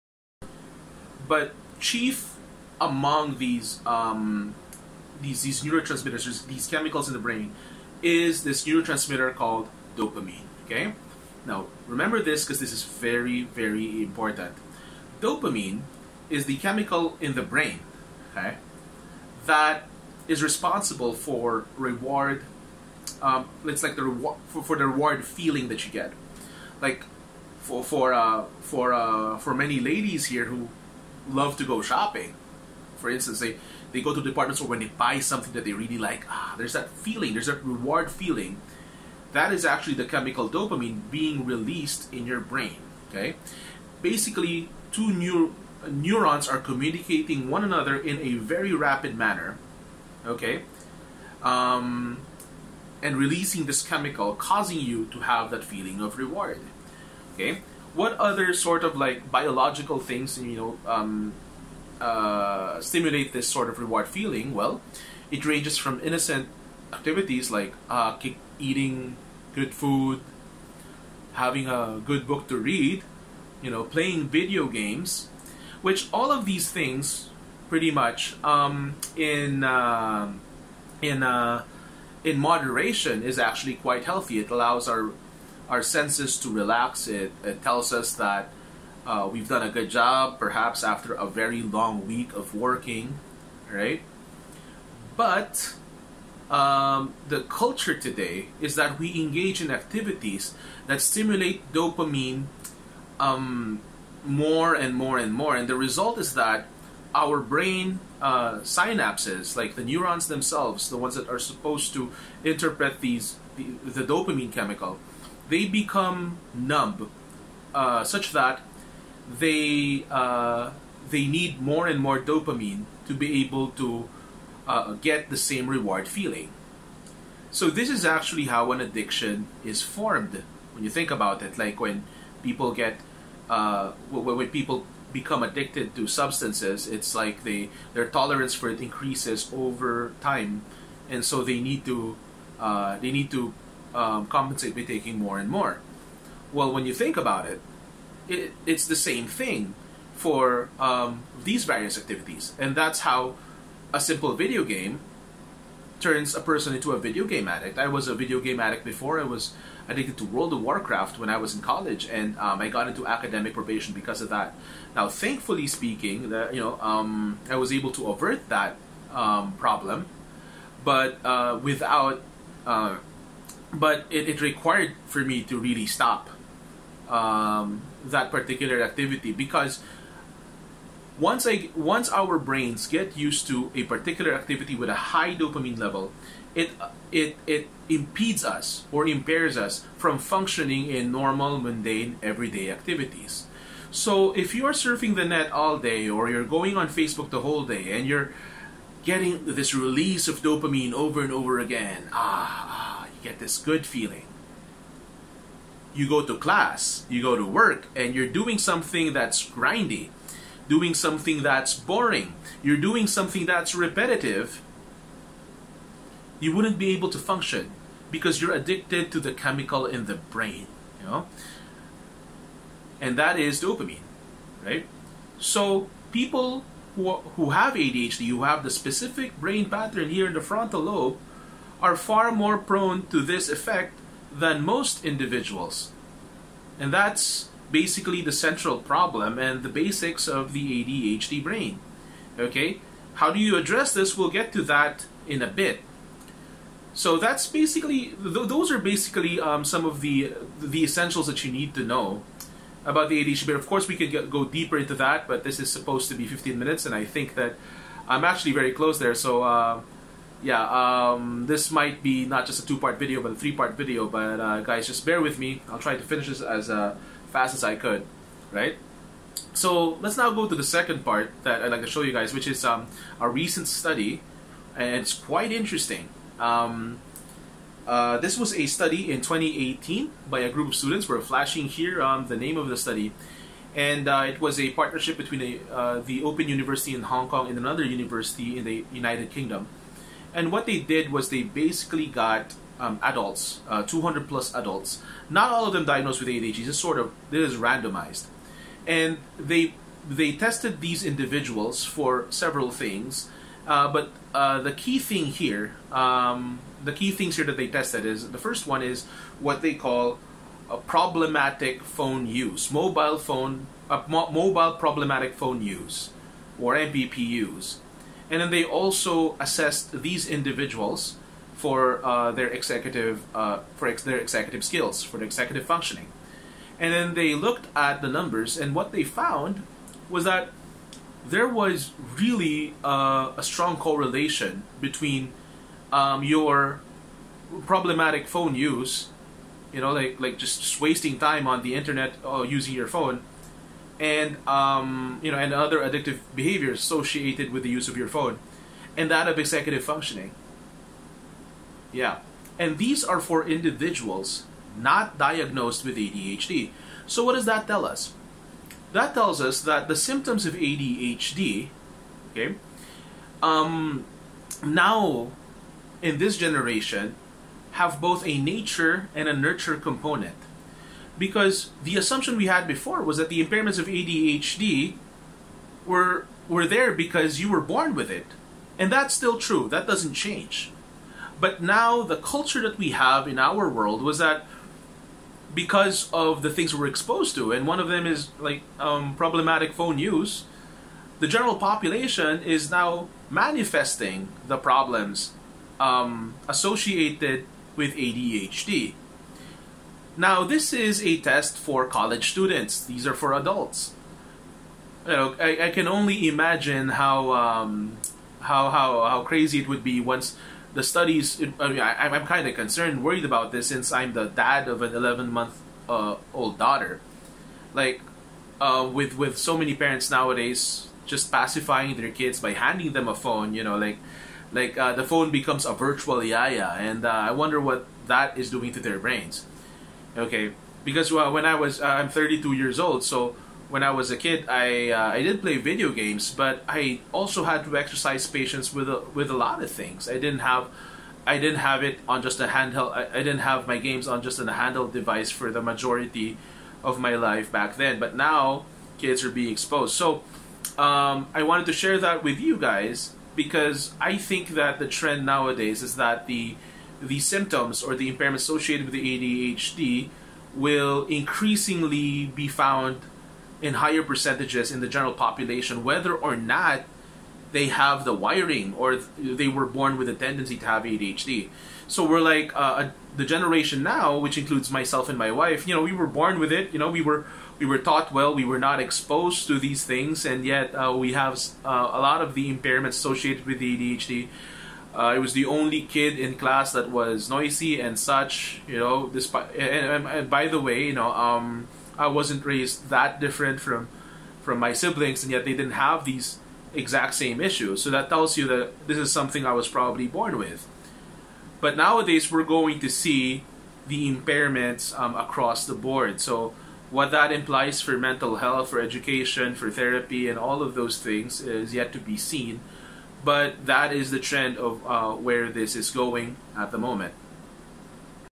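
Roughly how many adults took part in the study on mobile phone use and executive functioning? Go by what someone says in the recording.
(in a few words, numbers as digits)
200 plus.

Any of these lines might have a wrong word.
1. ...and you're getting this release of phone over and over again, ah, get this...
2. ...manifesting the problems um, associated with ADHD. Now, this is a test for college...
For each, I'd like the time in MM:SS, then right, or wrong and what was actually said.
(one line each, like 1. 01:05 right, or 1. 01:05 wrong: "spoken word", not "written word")
1. 03:17 wrong: "dopamine", not "phone"
2. 06:33 right.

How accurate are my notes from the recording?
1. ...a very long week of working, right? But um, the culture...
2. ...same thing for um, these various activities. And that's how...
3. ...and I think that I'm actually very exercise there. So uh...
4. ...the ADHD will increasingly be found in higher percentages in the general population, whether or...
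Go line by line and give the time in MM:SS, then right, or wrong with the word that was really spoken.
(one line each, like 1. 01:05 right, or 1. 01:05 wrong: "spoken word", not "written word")
1. 01:31 right
2. 02:28 right
3. 04:16 wrong: "close", not "exercise"
4. 07:38 right.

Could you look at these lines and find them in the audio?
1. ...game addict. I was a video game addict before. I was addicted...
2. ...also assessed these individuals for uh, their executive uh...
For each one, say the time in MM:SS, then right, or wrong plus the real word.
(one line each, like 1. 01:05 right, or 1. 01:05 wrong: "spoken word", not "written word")
1. 02:37 right
2. 05:18 right.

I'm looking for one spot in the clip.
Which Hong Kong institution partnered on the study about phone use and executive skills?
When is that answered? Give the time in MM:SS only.
04:46.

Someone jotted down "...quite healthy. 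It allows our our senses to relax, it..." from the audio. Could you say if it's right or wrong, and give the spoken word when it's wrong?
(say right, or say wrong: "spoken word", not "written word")
right.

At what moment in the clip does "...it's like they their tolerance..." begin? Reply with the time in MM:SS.
02:16.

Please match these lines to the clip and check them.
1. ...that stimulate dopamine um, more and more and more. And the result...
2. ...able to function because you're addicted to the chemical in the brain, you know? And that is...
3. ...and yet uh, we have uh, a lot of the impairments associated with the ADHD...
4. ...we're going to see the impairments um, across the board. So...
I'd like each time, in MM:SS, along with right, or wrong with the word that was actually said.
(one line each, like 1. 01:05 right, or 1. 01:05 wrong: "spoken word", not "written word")
1. 01:40 right
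2. 03:36 right
3. 08:00 right
4. 08:22 right.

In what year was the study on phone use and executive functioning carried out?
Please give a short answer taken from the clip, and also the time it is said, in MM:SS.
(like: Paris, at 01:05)
2018, at 04:39.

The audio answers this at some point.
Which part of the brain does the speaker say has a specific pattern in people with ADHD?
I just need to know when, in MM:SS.
03:50.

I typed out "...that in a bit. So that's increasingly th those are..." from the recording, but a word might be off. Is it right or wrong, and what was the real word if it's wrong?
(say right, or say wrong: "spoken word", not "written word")
wrong: "basically", not "increasingly".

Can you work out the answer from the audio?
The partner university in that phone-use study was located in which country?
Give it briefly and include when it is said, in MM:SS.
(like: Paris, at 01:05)
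United Kingdom, at 04:48.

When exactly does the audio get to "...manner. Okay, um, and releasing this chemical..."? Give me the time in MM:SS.
00:49.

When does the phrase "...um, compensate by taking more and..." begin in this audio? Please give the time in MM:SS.
02:23.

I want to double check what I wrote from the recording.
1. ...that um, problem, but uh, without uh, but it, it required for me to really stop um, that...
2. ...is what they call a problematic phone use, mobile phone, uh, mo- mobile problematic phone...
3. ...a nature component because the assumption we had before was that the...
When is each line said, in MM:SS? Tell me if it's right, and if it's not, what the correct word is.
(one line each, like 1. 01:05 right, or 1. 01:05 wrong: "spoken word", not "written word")
1. 02:48 right
2. 05:08 right
3. 06:09 wrong: "nurture", not "nature".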